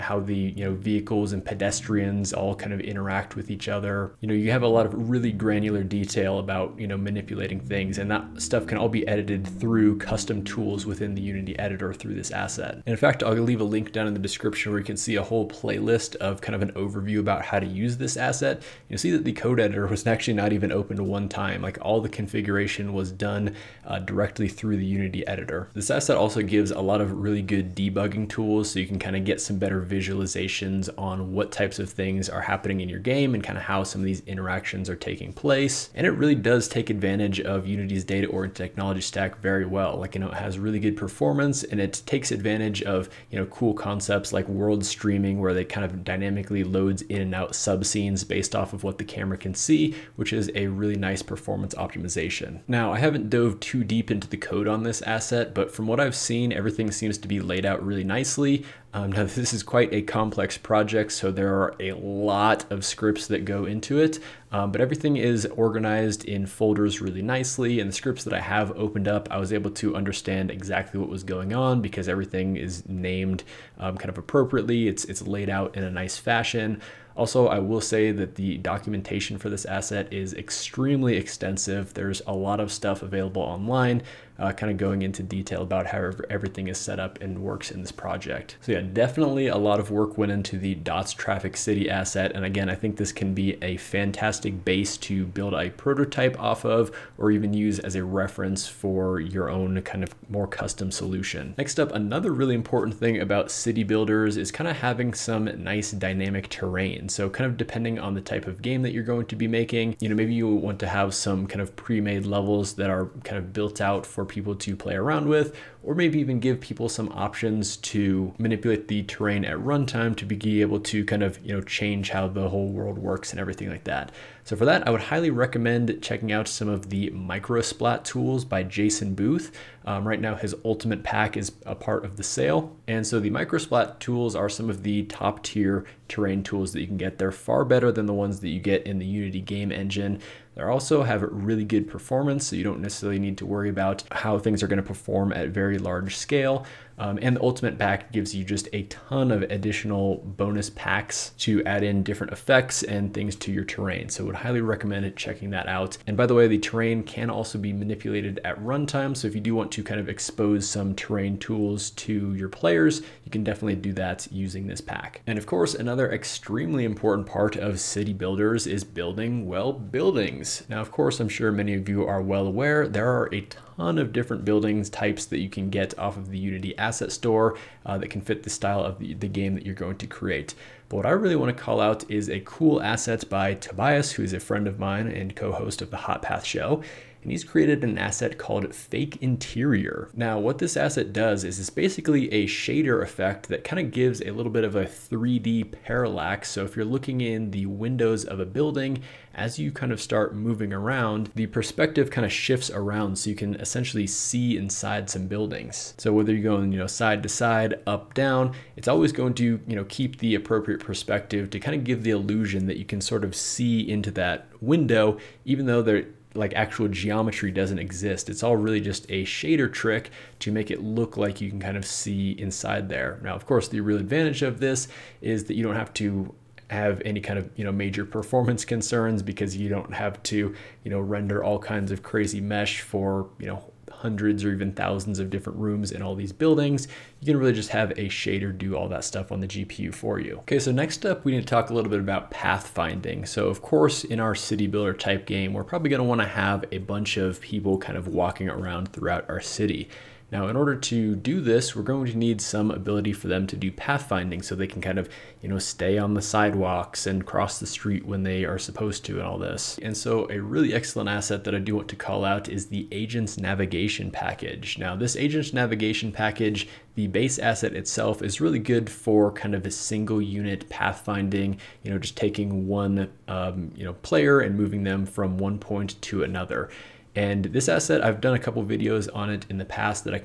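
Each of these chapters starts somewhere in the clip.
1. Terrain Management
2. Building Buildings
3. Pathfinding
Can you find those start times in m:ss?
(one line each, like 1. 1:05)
1. 1:40
2. 2:44
3. 4:00.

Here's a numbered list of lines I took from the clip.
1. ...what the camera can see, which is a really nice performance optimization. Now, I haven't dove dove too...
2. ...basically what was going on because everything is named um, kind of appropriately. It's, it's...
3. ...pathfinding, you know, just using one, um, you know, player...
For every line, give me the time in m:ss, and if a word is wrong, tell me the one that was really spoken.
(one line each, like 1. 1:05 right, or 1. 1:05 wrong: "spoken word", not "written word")
1. 0:48 right
2. 1:10 wrong: "exactly", not "basically"
3. 4:30 wrong: "taking", not "using".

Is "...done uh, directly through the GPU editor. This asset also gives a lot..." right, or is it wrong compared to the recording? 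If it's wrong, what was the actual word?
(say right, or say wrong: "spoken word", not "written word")
wrong: "Unity", not "GPU".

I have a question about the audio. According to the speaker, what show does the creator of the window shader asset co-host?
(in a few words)
Hot Path Show.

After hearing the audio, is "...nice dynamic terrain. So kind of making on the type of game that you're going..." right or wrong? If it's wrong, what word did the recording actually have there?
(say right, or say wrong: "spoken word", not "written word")
wrong: "depending", not "making".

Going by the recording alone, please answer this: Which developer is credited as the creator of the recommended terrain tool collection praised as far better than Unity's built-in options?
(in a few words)
Jason Booth.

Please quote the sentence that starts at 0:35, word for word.
And it really does take advantage of Unity's data-oriented technology stack very well.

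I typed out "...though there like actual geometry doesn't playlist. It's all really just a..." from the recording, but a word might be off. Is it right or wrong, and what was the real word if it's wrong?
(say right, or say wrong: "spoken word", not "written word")
wrong: "exist", not "playlist".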